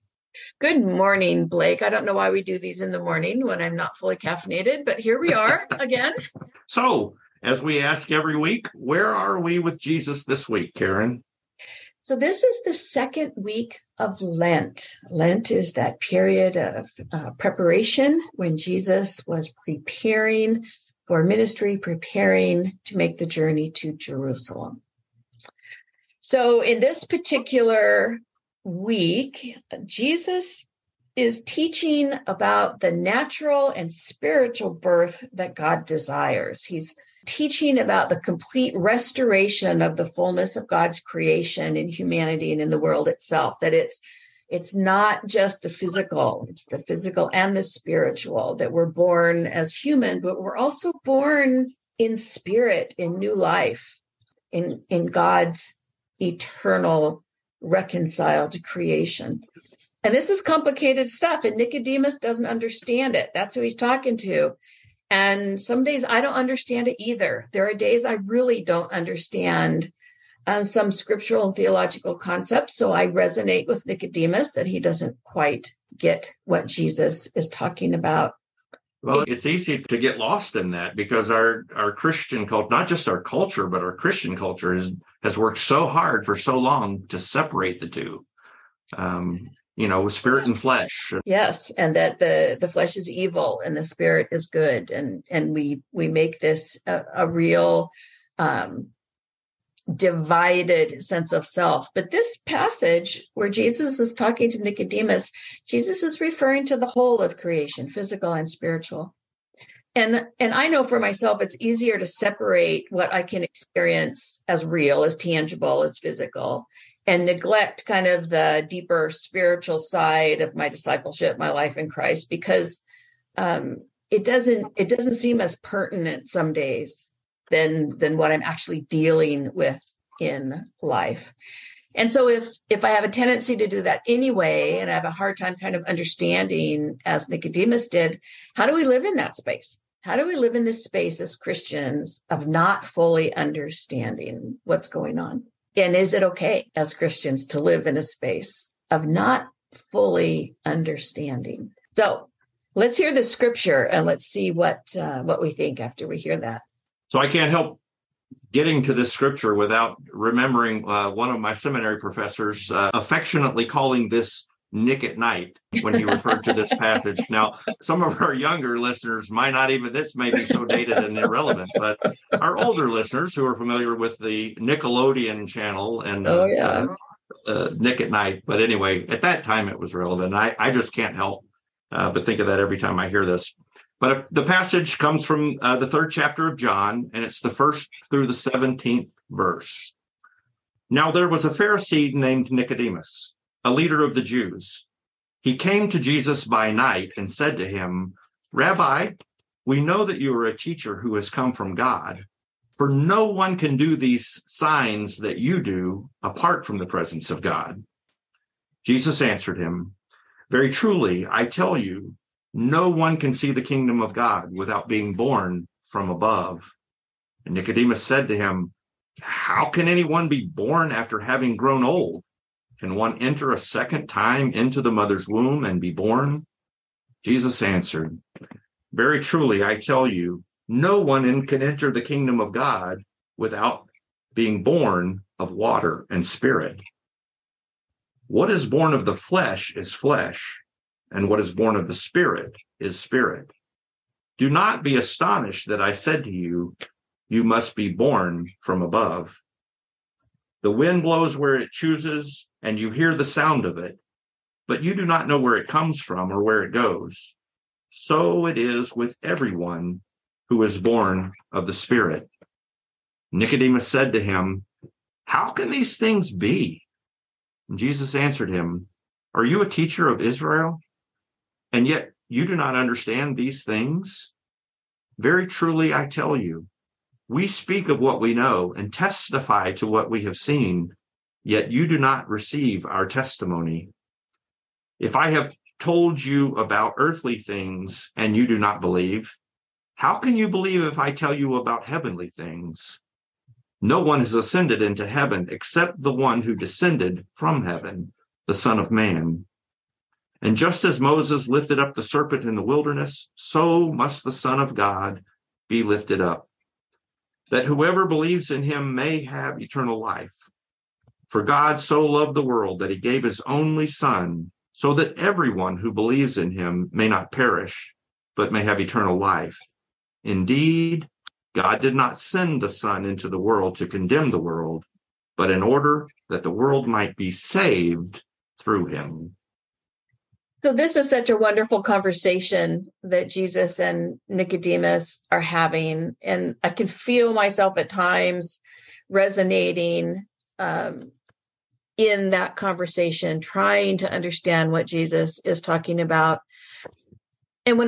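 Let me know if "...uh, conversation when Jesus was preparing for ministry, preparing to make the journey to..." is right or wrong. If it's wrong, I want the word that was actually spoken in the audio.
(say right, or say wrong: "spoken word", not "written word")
wrong: "preparation", not "conversation".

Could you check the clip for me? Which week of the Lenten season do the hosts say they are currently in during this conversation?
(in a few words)
Second week.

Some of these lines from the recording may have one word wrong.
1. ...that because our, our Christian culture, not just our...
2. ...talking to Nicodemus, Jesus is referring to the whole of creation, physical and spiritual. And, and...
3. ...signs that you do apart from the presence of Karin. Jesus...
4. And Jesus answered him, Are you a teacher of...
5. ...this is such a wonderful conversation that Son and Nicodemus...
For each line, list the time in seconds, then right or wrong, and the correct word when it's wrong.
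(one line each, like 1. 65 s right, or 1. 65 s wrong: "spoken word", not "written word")
1. 80 s right
2. 104 s right
3. 204 s wrong: "God", not "Karin"
4. 267 s right
5. 330 s wrong: "Jesus", not "Son".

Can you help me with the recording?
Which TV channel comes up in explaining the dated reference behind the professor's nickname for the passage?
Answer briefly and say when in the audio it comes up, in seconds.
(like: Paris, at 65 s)
Nickelodeon, at 174 s.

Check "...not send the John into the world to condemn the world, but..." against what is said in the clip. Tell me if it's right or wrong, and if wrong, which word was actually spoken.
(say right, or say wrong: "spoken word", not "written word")
wrong: "Son", not "John".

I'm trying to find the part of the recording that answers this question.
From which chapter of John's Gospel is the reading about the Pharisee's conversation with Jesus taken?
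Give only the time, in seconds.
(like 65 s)
185 s.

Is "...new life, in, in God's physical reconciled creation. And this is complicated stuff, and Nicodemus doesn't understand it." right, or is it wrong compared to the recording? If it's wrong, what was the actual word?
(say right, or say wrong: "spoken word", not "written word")
wrong: "eternal", not "physical".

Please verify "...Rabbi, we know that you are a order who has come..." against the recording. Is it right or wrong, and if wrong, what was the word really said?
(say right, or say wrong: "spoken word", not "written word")
wrong: "teacher", not "order".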